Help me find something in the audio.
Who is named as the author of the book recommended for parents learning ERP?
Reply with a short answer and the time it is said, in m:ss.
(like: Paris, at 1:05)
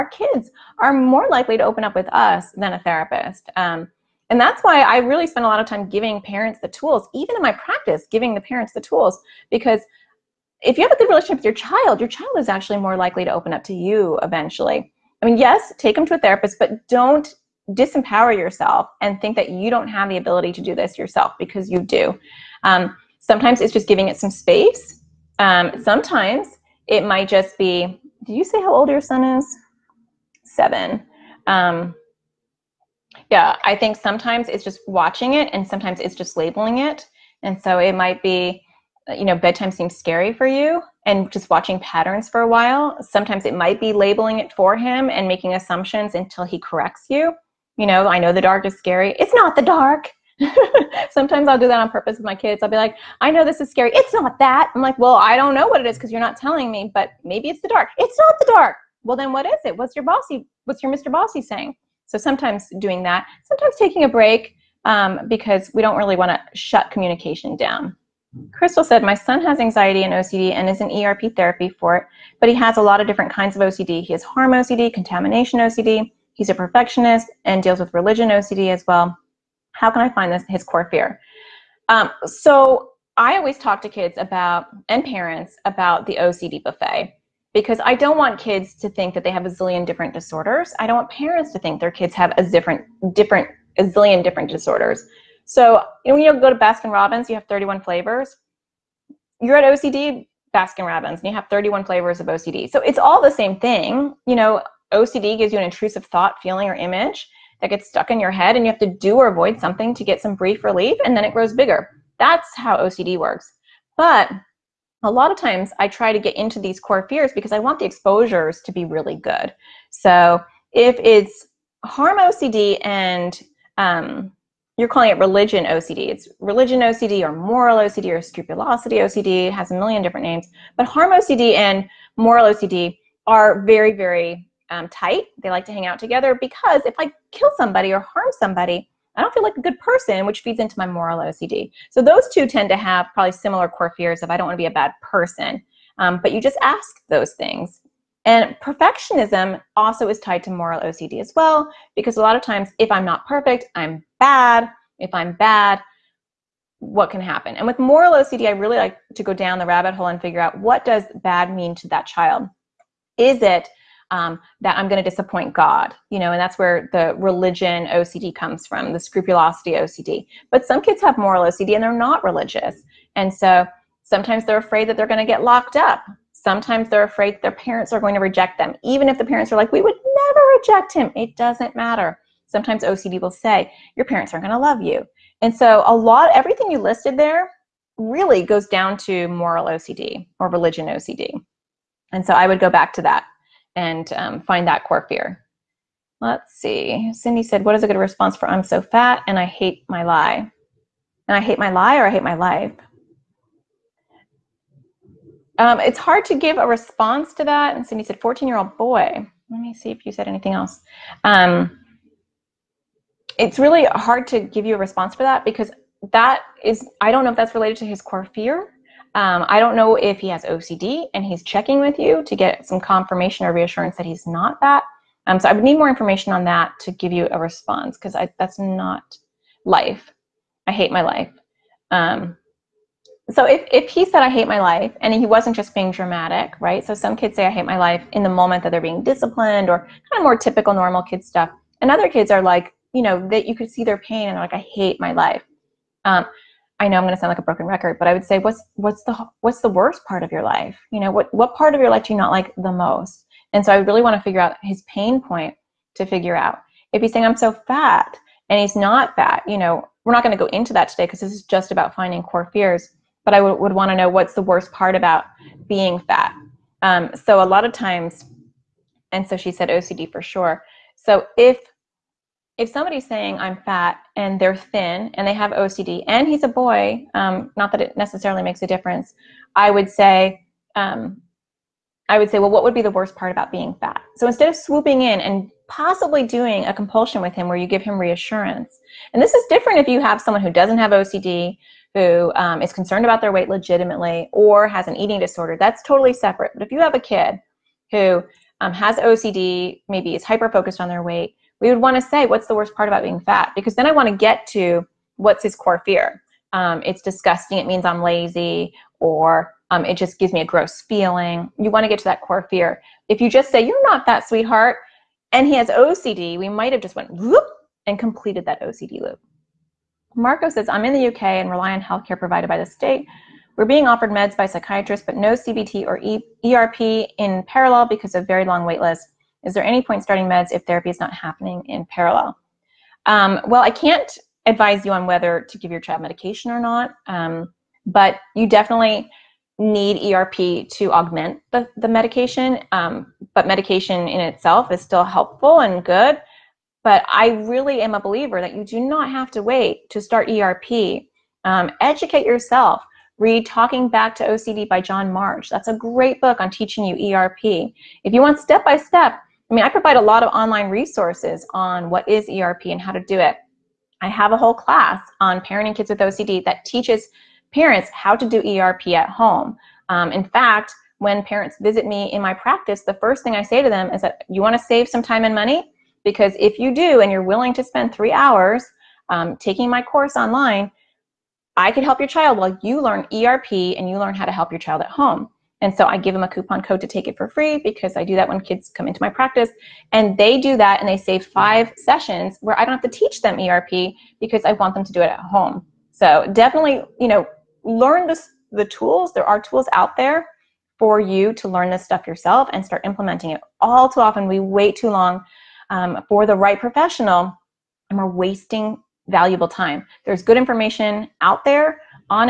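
John March, at 5:54.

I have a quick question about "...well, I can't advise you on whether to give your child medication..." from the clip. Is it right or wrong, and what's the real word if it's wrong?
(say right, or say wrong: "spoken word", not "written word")
right.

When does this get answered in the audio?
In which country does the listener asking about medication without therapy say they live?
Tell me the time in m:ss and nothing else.
5:21.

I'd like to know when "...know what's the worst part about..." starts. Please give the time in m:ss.
4:23.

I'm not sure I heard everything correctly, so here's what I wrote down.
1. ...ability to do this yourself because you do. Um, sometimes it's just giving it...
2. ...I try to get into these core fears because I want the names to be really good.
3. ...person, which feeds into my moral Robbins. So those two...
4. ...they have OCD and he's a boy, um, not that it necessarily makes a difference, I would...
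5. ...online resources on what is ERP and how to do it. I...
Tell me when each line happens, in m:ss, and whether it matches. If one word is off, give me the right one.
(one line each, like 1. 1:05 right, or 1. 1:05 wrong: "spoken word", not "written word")
1. 0:20 right
2. 1:55 wrong: "exposures", not "names"
3. 2:19 wrong: "OCD", not "Robbins"
4. 4:35 right
5. 6:00 right.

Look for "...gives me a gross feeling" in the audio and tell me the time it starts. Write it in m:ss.
5:10.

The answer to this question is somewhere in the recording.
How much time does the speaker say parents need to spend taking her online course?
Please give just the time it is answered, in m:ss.
6:17.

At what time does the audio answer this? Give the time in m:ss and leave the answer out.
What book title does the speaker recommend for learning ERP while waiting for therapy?
5:53.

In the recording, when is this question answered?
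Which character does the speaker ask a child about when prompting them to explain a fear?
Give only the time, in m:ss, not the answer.
1:00.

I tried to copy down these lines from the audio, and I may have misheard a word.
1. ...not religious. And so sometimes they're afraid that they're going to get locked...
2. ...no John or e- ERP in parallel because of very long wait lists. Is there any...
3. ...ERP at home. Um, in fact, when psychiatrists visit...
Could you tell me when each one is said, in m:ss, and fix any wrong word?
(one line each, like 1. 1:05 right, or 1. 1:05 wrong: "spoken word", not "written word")
1. 2:51 right
2. 5:25 wrong: "CBT", not "John"
3. 6:08 wrong: "parents", not "psychiatrists".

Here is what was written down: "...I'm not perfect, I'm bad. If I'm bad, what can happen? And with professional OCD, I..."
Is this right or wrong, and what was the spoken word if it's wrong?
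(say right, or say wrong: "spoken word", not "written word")
wrong: "moral", not "professional".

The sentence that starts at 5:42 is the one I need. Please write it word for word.
Um, but medication in itself is still helpful and good.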